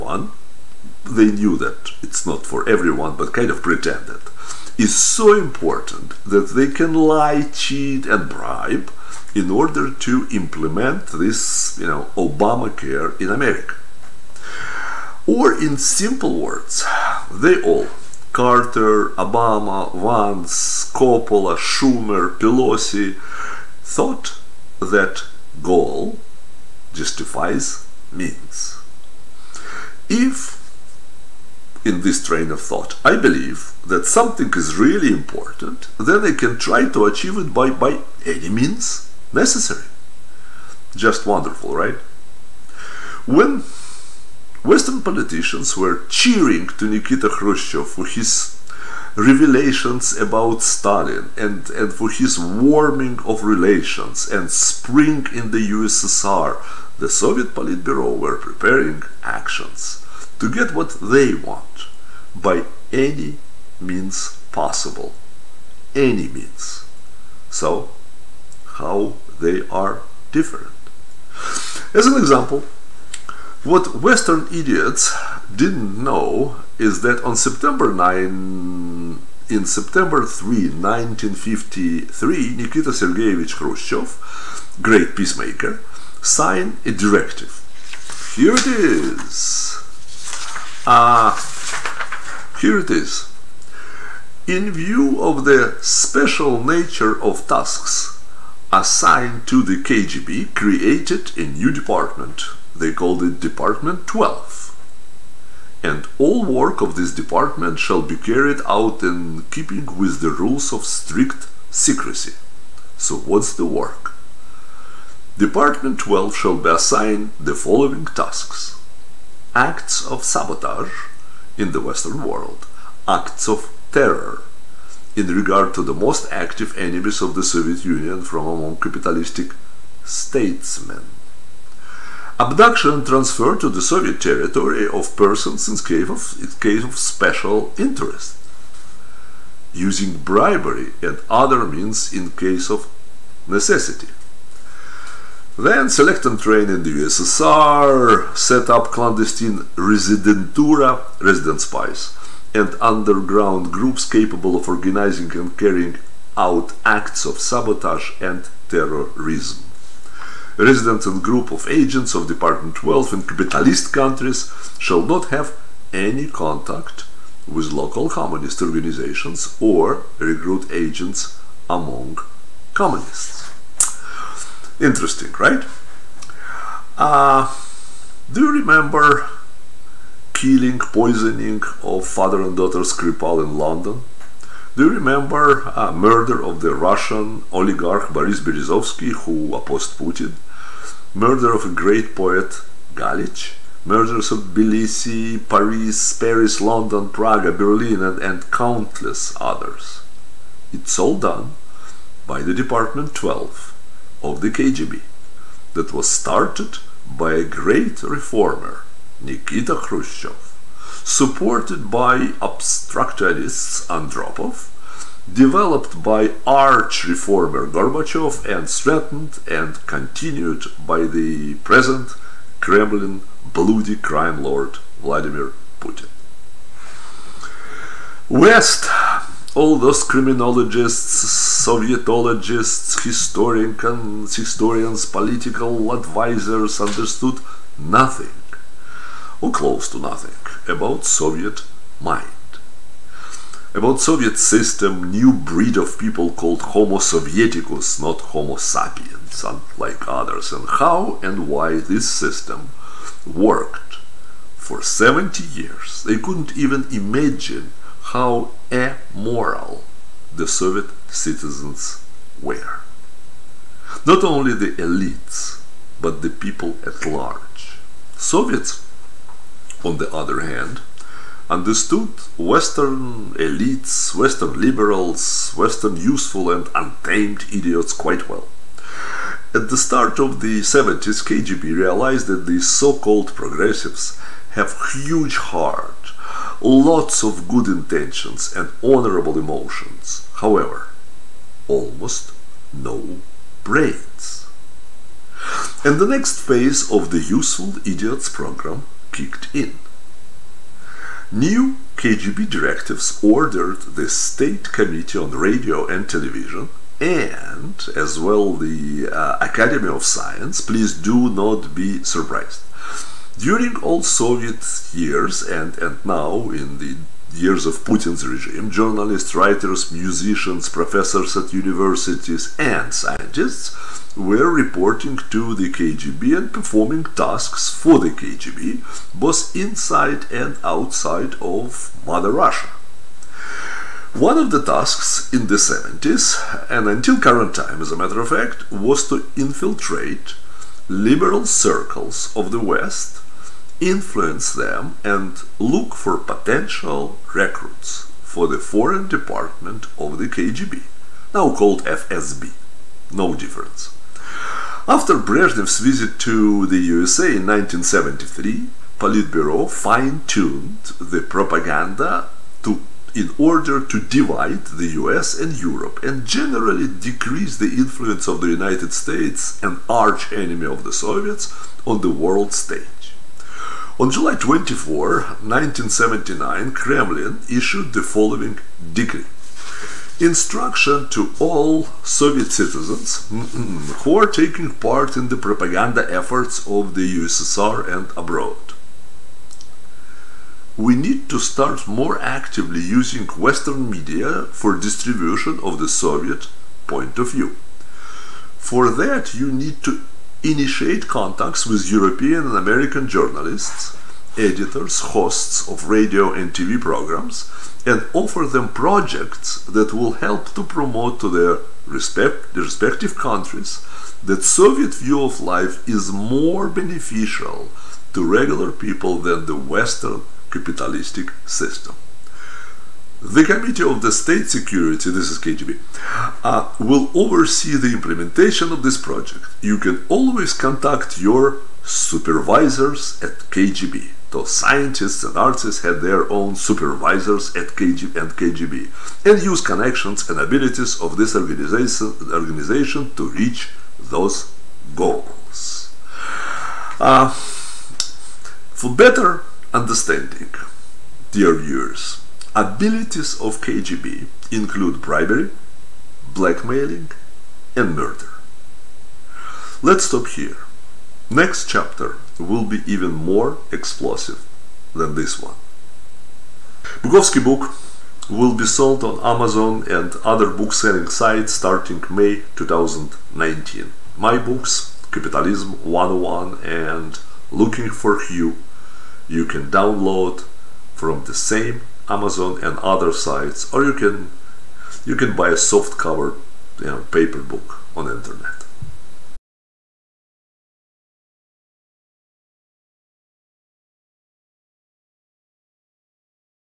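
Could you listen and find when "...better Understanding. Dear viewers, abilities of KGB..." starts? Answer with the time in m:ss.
7:28.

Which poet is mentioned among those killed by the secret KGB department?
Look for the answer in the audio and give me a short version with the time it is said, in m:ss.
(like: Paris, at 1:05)
Galich, at 3:12.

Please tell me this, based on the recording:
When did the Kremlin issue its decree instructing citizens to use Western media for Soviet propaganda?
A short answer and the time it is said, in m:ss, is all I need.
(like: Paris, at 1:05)
July 24, 1979, at 6:14.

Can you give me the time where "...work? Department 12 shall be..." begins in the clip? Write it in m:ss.
1:53.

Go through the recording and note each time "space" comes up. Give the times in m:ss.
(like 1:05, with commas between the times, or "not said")
not said.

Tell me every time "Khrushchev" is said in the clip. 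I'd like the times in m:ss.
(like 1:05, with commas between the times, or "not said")
0:47, 1:23, 3:29.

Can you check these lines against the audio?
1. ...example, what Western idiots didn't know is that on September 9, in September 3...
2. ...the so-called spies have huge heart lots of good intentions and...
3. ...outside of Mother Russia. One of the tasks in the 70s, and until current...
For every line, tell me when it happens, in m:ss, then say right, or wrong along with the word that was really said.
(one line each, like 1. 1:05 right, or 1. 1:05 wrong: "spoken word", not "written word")
1. 1:12 right
2. 4:42 wrong: "progressives", not "spies"
3. 5:30 right.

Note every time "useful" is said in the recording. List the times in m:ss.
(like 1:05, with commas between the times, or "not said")
4:35, 4:57.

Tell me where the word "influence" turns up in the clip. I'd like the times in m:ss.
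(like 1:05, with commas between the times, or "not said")
5:43, 6:07.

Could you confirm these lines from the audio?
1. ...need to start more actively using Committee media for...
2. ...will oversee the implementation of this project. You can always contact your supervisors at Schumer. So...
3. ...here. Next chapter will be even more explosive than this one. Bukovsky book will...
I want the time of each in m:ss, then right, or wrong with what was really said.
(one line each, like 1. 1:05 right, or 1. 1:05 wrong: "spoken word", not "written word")
1. 6:30 wrong: "Western", not "Committee"
2. 7:06 wrong: "KGB", not "Schumer"
3. 7:40 right.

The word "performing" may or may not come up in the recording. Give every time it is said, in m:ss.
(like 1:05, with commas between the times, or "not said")
5:26.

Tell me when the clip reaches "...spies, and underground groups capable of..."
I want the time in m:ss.
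2:31.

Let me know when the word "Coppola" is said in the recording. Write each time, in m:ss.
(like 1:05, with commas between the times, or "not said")
0:20.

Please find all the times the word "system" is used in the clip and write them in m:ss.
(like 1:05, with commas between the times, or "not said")
4:04, 4:12, 7:01.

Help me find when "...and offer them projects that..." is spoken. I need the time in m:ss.
6:47.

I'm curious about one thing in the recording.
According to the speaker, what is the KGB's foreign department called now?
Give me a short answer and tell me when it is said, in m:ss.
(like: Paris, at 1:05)
FSB, at 5:51.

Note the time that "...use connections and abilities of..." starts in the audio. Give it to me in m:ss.
7:19.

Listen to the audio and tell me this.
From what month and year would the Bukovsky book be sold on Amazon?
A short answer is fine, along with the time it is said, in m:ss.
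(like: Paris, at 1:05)
May 2019, at 7:52.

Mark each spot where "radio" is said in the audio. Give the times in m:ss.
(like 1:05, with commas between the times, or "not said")
5:05, 6:45.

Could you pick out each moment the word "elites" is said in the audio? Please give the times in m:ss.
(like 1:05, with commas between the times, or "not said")
4:24, 4:33.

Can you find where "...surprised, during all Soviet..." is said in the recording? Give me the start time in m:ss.
5:12.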